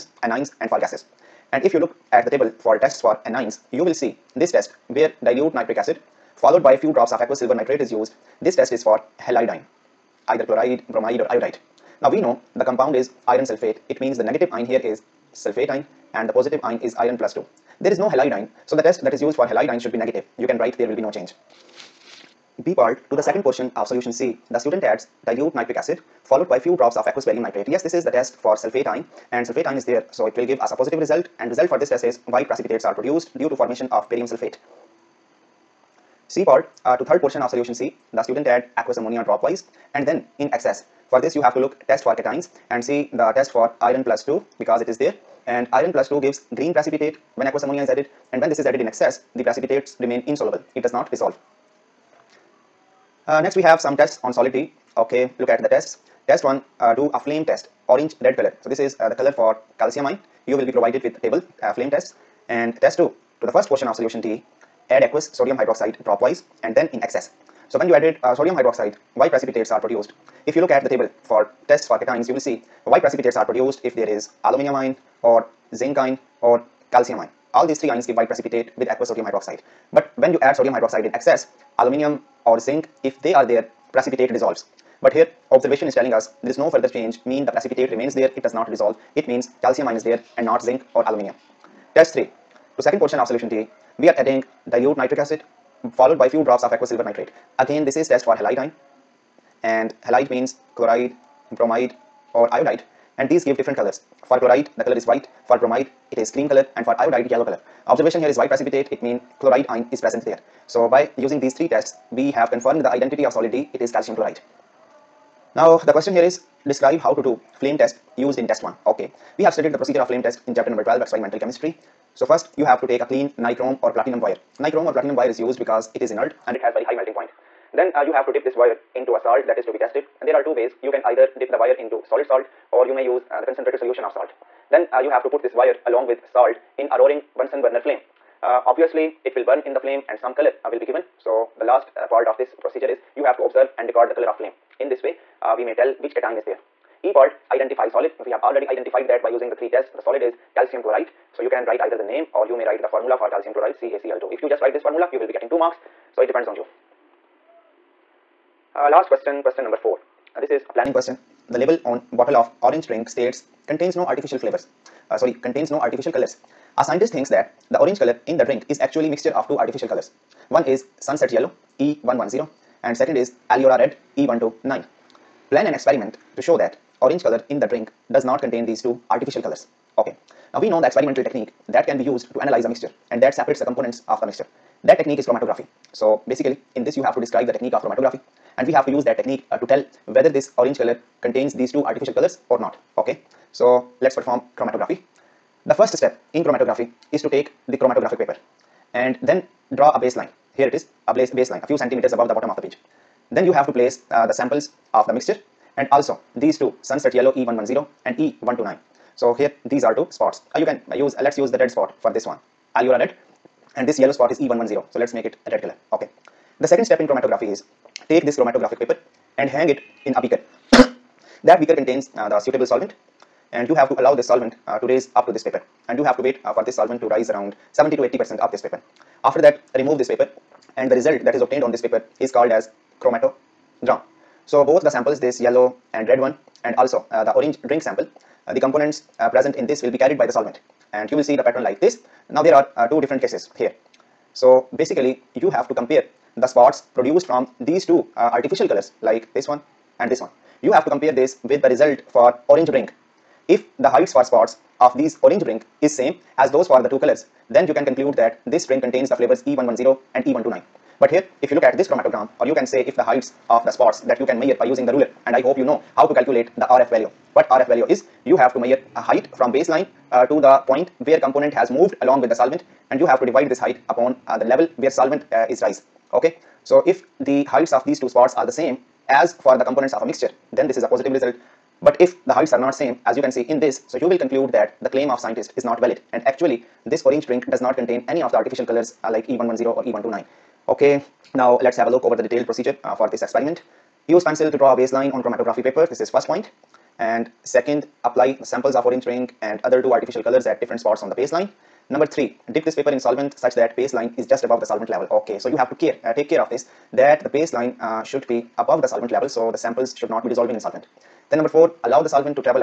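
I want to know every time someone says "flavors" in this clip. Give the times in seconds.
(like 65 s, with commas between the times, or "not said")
164 s, 259 s.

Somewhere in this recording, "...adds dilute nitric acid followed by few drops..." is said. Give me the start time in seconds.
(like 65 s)
24 s.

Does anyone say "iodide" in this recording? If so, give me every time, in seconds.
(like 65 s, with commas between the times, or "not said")
11 s, 102 s, 106 s.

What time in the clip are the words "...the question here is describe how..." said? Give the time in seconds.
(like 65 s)
115 s.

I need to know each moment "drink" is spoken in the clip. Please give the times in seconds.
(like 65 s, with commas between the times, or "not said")
162 s, 168 s, 177 s, 237 s, 287 s, 299 s.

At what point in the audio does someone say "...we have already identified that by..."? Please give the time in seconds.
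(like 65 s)
148 s.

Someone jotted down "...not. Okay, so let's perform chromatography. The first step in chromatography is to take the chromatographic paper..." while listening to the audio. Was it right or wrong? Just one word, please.
right.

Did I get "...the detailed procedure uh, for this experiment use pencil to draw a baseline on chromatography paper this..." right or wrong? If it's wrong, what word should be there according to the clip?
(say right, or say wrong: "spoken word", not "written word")
right.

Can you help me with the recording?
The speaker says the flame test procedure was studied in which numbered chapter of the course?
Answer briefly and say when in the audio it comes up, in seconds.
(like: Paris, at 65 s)
12, at 120 s.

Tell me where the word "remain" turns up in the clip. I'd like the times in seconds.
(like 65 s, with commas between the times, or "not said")
50 s, 87 s.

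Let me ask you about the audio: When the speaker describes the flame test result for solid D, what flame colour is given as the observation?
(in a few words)
orange red.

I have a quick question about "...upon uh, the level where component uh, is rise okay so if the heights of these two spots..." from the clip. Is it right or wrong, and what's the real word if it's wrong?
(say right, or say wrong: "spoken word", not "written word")
wrong: "solvent", not "component".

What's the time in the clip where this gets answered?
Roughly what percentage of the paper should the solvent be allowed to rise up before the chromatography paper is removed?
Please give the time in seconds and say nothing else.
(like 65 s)
227 s.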